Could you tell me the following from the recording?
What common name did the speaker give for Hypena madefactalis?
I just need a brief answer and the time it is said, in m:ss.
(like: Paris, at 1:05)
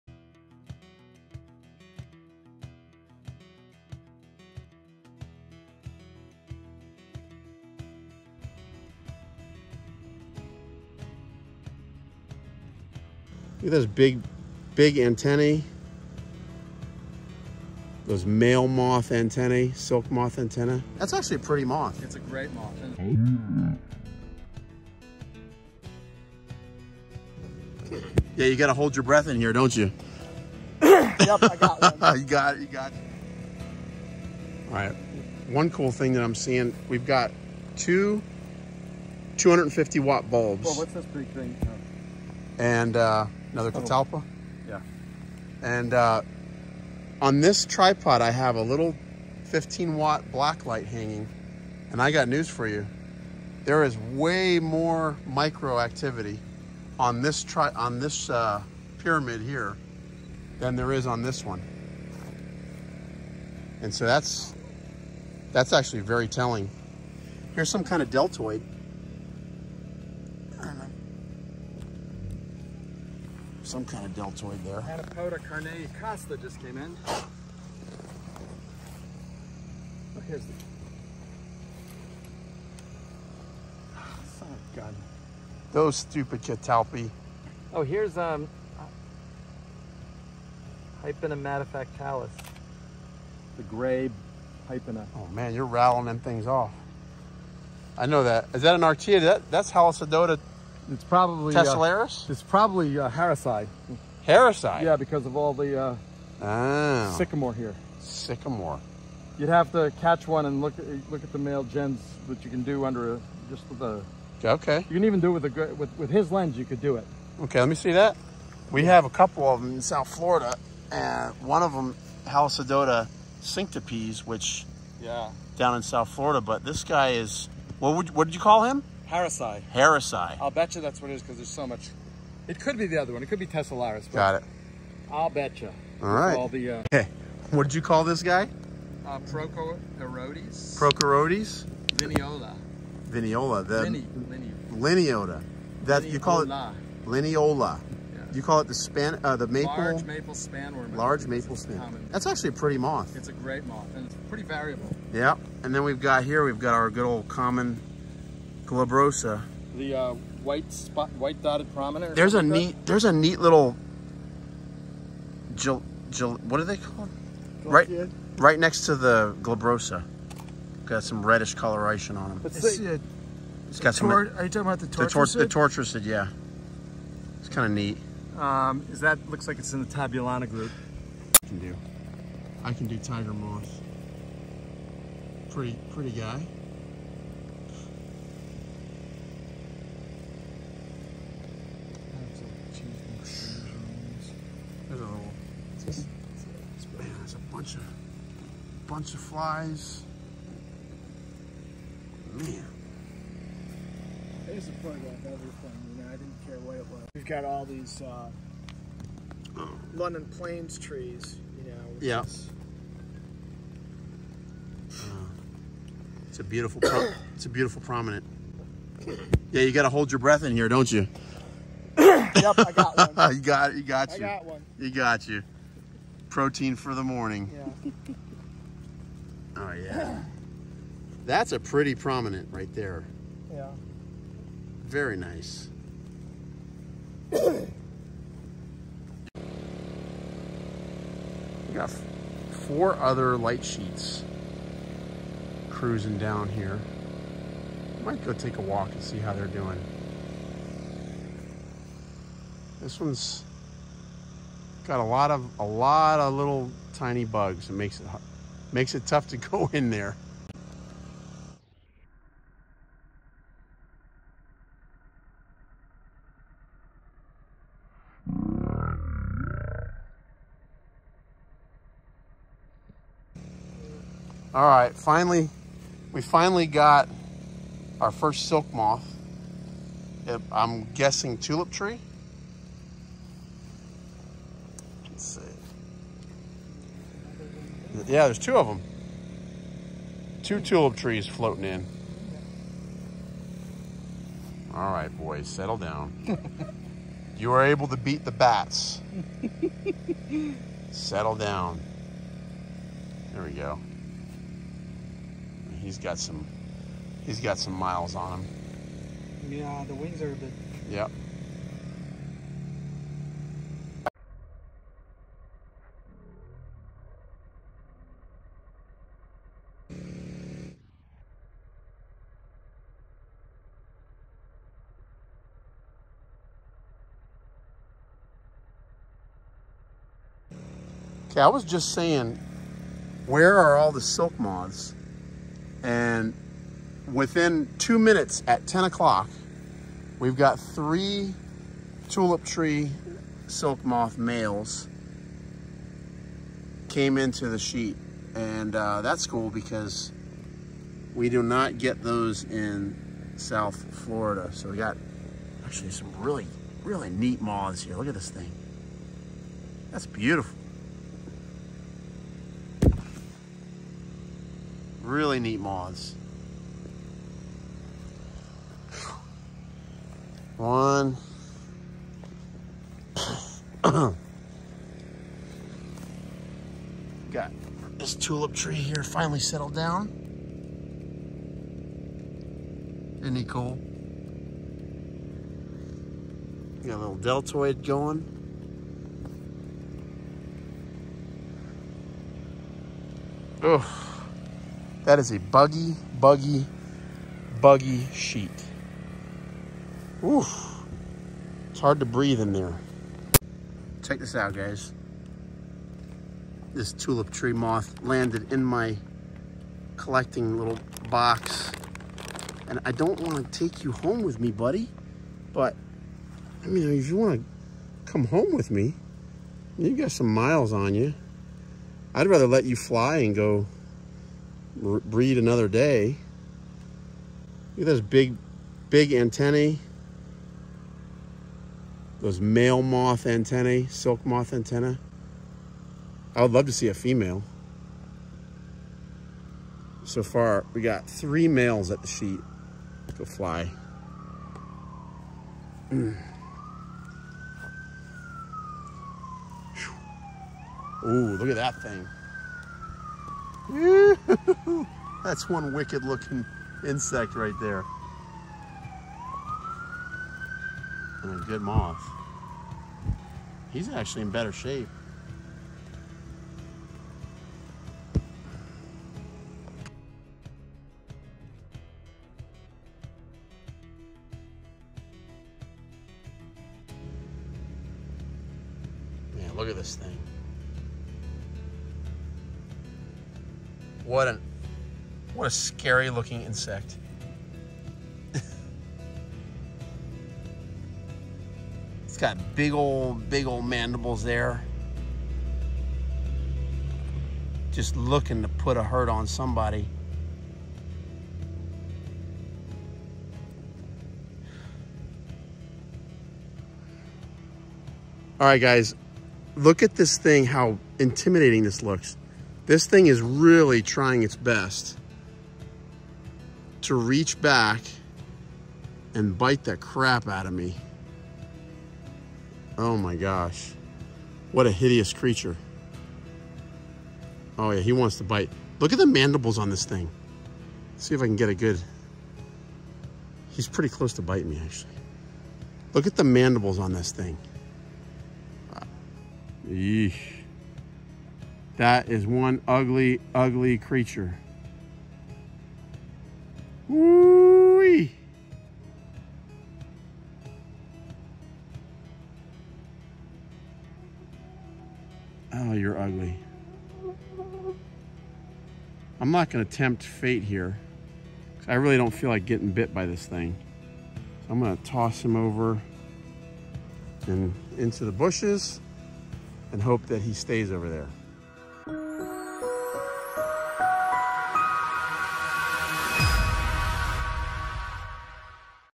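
gray hypena, at 1:33.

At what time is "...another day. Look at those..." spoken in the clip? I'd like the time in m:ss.
7:05.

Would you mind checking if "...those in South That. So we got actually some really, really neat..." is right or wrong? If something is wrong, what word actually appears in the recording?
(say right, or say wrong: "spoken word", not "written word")
wrong: "Florida", not "That".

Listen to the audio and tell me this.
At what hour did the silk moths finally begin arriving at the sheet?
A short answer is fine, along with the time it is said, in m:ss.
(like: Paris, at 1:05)
10 o'clock, at 5:38.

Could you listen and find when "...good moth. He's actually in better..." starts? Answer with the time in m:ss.
7:41.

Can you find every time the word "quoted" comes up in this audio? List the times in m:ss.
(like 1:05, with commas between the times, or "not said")
not said.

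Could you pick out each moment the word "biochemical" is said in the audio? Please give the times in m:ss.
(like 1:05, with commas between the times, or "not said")
not said.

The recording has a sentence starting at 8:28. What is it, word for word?
All right, guys, look at this thing, how intimidating this looks.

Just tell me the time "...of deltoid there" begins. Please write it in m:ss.
1:14.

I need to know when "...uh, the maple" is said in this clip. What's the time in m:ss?
2:29.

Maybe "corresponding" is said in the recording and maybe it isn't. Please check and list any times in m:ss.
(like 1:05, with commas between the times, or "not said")
not said.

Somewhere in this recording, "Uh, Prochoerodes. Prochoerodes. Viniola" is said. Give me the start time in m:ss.
2:19.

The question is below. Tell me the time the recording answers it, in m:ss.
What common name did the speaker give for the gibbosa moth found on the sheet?
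2:41.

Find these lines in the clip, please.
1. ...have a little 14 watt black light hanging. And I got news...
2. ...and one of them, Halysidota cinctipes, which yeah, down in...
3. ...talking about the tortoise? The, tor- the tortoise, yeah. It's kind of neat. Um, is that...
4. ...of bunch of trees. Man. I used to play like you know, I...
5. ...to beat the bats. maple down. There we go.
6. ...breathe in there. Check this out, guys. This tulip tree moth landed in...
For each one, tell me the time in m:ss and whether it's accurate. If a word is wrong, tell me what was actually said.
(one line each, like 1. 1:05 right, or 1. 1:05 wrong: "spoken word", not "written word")
1. 0:48 wrong: "15", not "14"
2. 2:00 right
3. 2:54 right
4. 3:17 wrong: "flies", not "trees"
5. 4:57 wrong: "settle", not "maple"
6. 6:42 right.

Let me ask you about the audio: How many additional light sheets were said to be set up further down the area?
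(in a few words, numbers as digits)
4.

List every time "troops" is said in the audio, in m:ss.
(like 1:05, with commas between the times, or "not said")
not said.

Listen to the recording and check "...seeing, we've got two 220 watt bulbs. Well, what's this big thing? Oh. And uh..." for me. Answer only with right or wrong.
wrong.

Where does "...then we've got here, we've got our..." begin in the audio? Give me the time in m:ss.
2:35.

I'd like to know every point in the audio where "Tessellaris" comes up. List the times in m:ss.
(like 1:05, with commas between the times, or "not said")
1:41, 2:13.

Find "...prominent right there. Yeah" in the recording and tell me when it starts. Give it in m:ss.
3:51.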